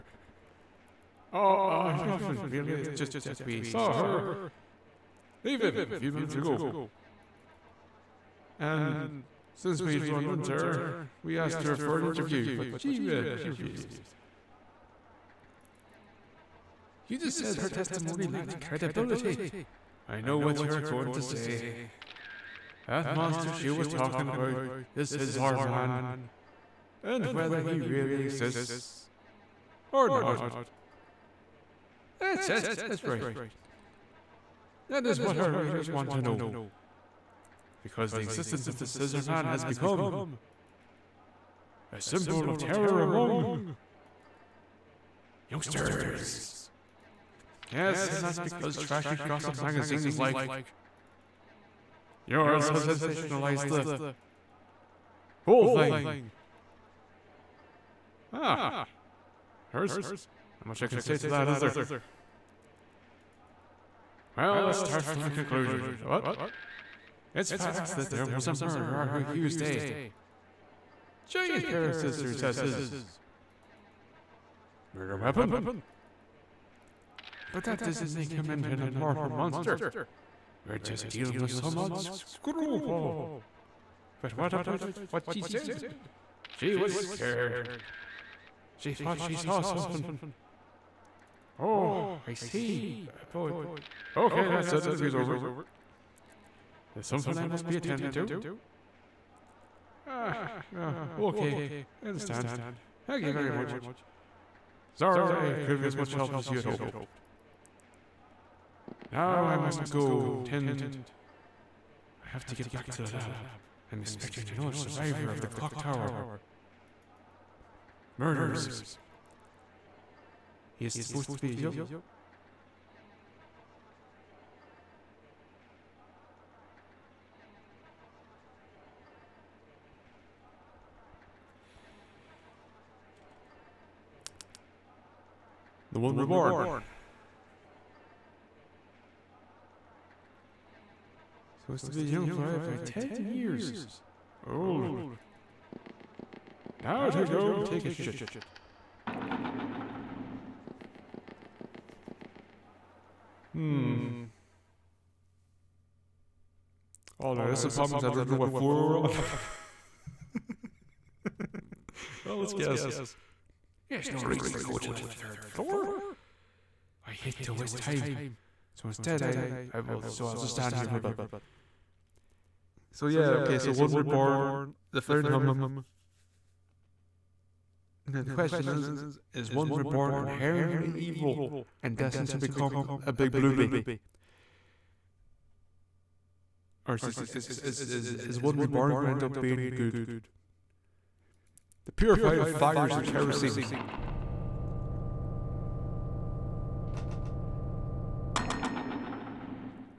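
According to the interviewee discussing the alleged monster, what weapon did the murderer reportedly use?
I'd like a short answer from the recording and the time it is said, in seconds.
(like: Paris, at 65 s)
Giant pair of scissors, at 71 s.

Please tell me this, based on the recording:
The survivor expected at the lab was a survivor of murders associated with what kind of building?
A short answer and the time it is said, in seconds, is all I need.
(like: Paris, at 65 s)
Clock tower, at 115 s.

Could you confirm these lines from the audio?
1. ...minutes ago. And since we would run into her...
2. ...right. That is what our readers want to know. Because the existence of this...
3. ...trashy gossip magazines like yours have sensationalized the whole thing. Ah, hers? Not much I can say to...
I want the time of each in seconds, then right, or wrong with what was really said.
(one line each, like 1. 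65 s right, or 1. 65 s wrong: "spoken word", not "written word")
1. 6 s right
2. 33 s right
3. 48 s right.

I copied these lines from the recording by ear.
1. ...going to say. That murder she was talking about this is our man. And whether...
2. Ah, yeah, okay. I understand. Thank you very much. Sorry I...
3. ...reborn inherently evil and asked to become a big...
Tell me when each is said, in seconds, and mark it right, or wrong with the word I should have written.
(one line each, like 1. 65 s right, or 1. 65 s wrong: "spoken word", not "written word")
1. 20 s wrong: "monster", not "murder"
2. 100 s right
3. 179 s wrong: "destined", not "asked".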